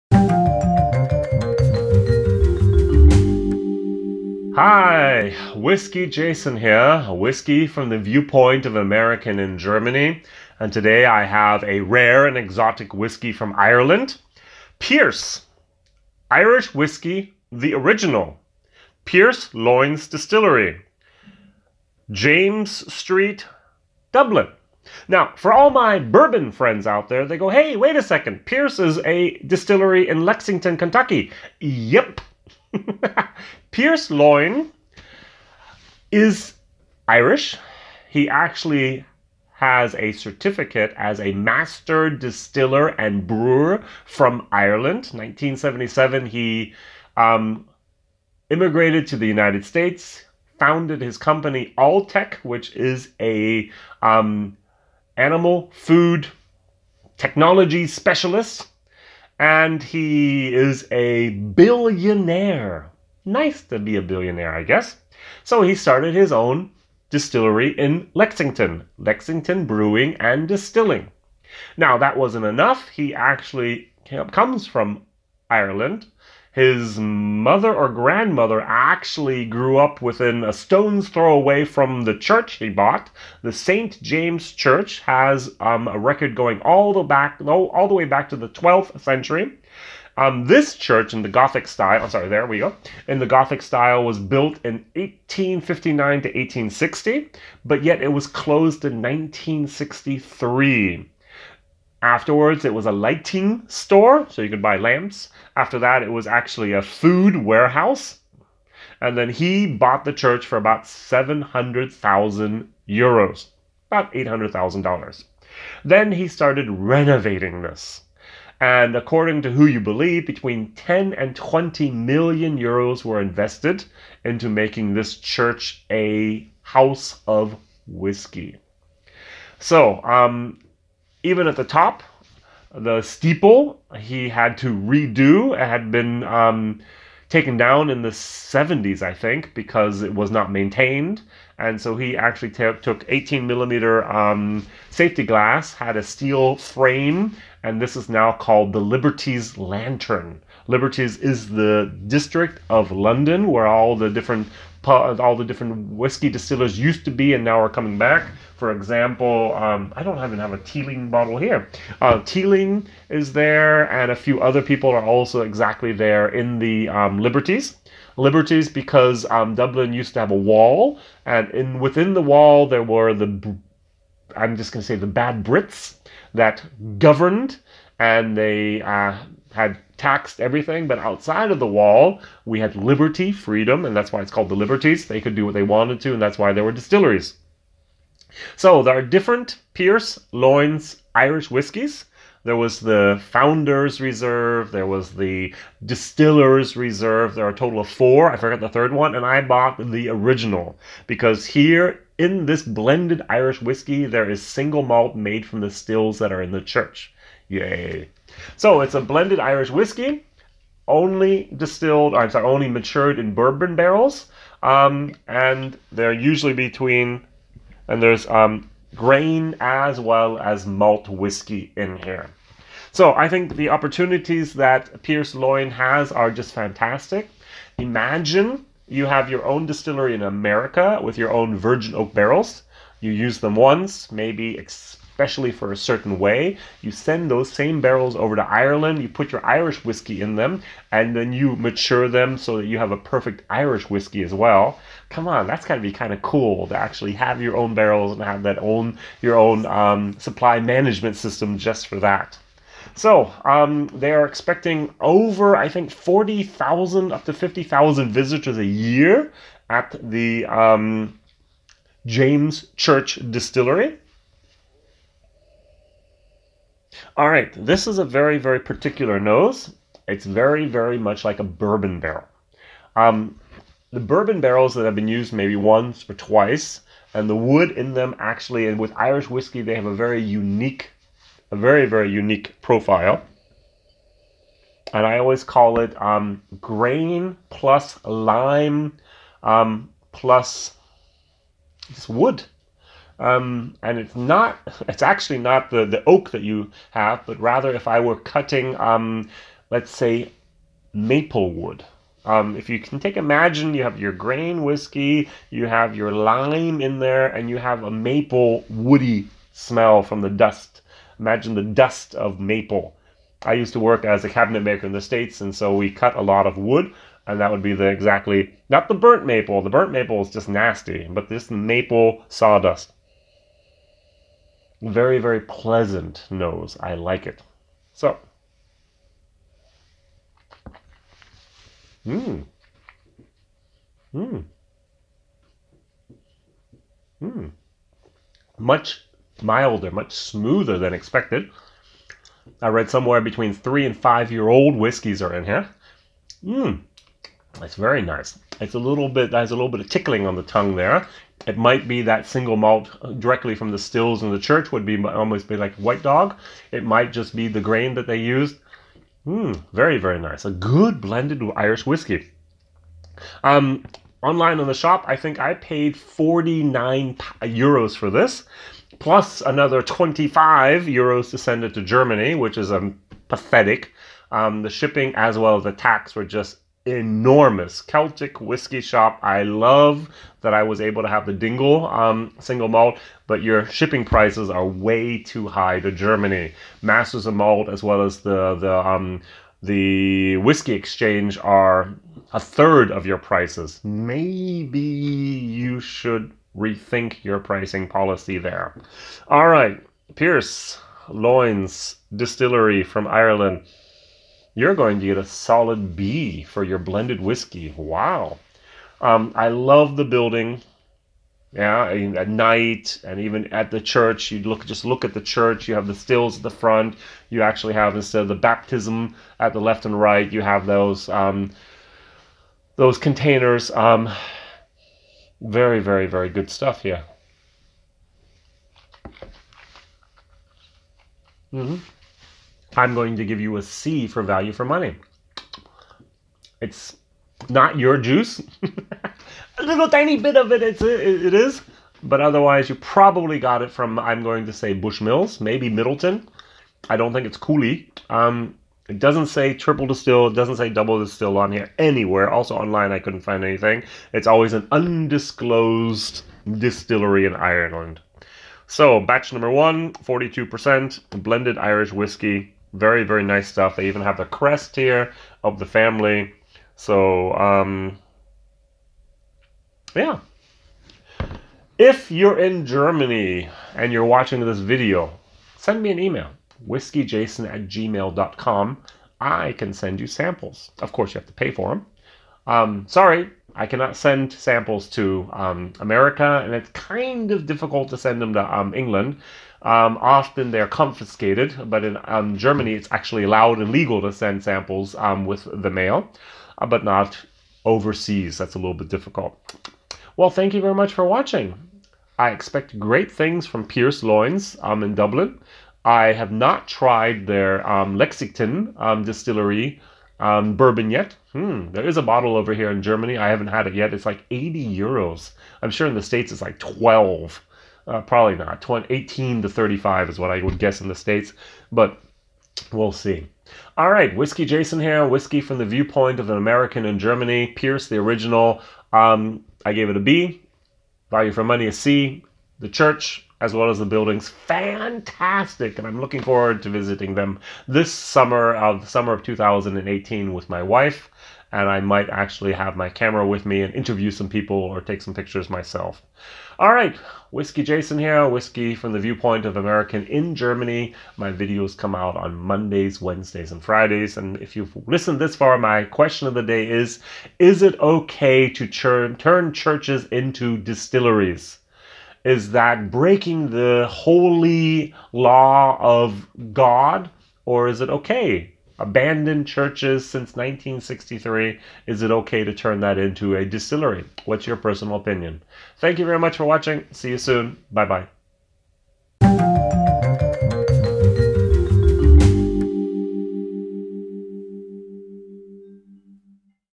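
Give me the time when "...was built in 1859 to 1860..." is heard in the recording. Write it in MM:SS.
01:34.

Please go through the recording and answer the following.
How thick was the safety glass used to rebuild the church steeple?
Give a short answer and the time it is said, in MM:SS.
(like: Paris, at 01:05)
18 millimeter, at 02:23.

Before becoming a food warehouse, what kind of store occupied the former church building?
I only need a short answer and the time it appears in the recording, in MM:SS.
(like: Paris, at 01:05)
lighting store, at 01:42.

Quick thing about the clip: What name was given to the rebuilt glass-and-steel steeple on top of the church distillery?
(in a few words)
Liberties Lantern.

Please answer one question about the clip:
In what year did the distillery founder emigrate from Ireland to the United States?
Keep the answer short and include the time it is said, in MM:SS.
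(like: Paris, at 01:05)
1977, at 00:45.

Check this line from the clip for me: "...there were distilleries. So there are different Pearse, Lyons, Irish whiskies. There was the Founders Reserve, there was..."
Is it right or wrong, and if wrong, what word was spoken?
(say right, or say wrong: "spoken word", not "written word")
right.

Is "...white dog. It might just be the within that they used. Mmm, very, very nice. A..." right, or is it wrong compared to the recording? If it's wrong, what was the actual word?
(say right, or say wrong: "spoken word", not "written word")
wrong: "grain", not "within".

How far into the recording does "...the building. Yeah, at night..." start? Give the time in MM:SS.
06:49.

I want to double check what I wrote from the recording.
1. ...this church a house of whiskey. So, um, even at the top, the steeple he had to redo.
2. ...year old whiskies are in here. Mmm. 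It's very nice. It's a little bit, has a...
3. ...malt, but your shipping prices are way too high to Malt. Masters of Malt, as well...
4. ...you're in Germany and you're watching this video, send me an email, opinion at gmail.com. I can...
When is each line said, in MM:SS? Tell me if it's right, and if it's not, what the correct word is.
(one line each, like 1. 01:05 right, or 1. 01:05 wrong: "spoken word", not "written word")
1. 02:04 right
2. 05:44 right
3. 06:22 wrong: "Germany", not "Malt"
4. 07:52 wrong: "whiskeyjason", not "opinion".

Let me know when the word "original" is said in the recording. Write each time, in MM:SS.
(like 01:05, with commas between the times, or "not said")
00:17, 03:20, 08:47.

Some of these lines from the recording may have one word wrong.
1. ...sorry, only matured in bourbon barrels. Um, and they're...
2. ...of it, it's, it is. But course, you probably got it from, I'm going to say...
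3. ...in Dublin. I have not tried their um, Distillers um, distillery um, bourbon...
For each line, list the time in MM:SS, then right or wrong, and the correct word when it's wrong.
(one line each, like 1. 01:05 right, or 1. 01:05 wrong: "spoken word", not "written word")
1. 03:32 right
2. 07:20 wrong: "otherwise", not "course"
3. 08:24 wrong: "Lexington", not "Distillers".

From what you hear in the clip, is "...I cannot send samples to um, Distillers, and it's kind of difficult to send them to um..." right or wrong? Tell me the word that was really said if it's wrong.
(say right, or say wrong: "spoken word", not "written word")
wrong: "America", not "Distillers".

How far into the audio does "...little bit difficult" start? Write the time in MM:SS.
08:18.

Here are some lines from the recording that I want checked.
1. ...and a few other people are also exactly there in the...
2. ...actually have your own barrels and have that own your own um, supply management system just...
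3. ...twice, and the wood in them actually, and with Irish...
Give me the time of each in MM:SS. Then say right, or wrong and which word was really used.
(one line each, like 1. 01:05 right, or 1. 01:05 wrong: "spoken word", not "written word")
1. 02:43 right
2. 04:06 right
3. 04:36 right.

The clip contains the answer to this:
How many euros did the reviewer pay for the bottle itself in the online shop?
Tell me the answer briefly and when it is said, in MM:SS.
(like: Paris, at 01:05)
49 euros, at 06:05.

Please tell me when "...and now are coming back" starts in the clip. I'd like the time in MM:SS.
02:37.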